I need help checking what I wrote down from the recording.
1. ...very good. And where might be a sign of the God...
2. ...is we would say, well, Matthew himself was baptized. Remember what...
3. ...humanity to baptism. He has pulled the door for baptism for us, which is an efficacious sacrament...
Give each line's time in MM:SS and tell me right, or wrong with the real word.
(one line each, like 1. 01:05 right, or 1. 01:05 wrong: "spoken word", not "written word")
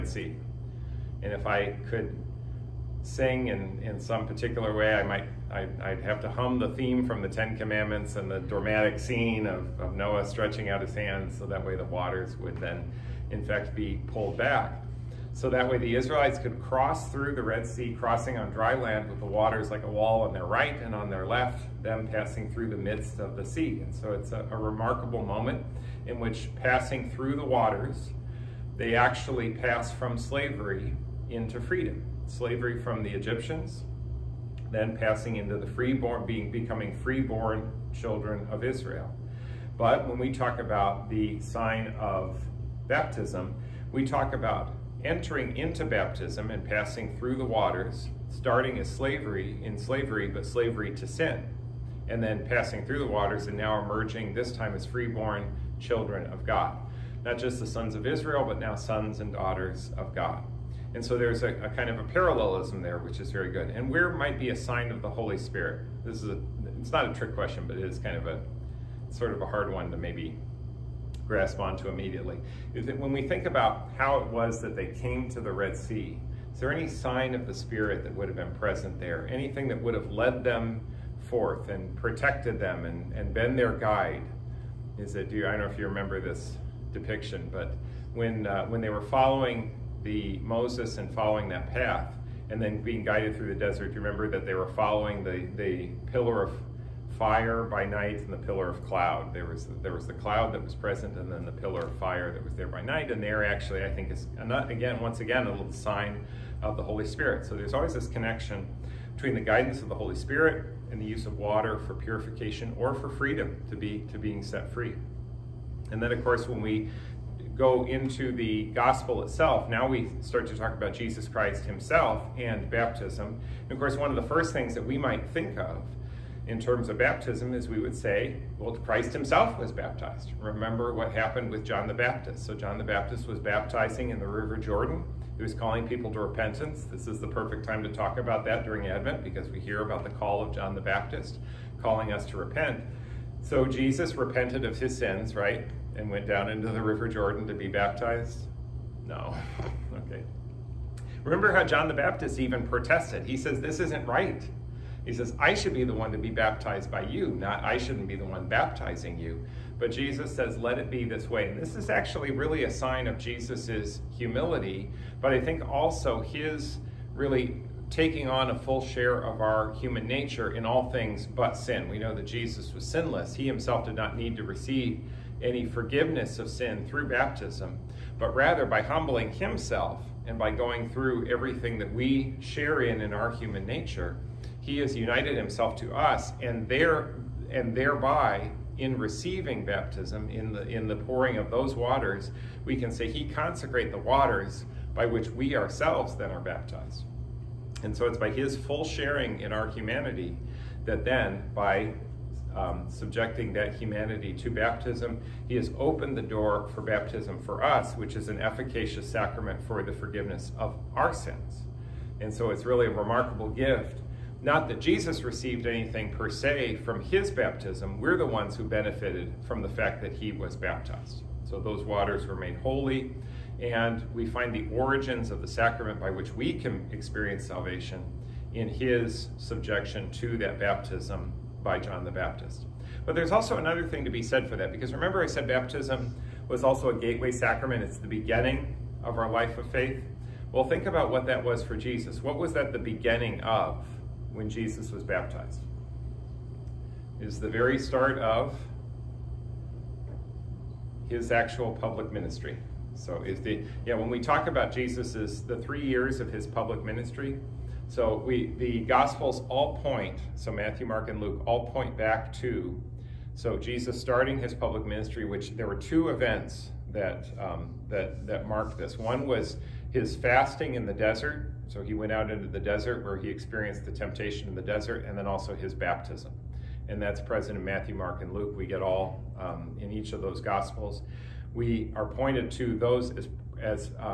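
1. 01:03 wrong: "Holy", not "God"
2. 02:07 wrong: "Christ", not "Matthew"
3. 03:23 wrong: "opened", not "pulled".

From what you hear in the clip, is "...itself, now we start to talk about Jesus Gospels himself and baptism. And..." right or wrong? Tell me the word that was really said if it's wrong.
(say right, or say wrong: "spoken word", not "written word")
wrong: "Christ", not "Gospels".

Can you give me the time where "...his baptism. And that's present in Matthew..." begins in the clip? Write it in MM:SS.
04:35.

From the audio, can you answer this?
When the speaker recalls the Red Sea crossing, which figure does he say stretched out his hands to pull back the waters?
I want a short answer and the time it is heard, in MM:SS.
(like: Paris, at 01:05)
Noah, at 00:09.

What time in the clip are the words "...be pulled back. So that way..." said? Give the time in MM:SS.
00:13.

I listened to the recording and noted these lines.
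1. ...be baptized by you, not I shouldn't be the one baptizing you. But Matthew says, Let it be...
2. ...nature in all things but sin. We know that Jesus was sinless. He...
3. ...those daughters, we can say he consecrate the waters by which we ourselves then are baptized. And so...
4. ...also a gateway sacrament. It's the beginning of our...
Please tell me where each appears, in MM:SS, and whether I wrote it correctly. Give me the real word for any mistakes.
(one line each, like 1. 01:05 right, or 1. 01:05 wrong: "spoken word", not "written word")
1. 02:36 wrong: "Jesus", not "Matthew"
2. 02:50 right
3. 03:11 wrong: "waters", not "daughters"
4. 03:56 right.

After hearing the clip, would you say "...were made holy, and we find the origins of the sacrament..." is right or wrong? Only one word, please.
right.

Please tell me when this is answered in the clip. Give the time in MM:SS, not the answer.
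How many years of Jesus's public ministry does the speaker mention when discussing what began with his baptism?
04:15.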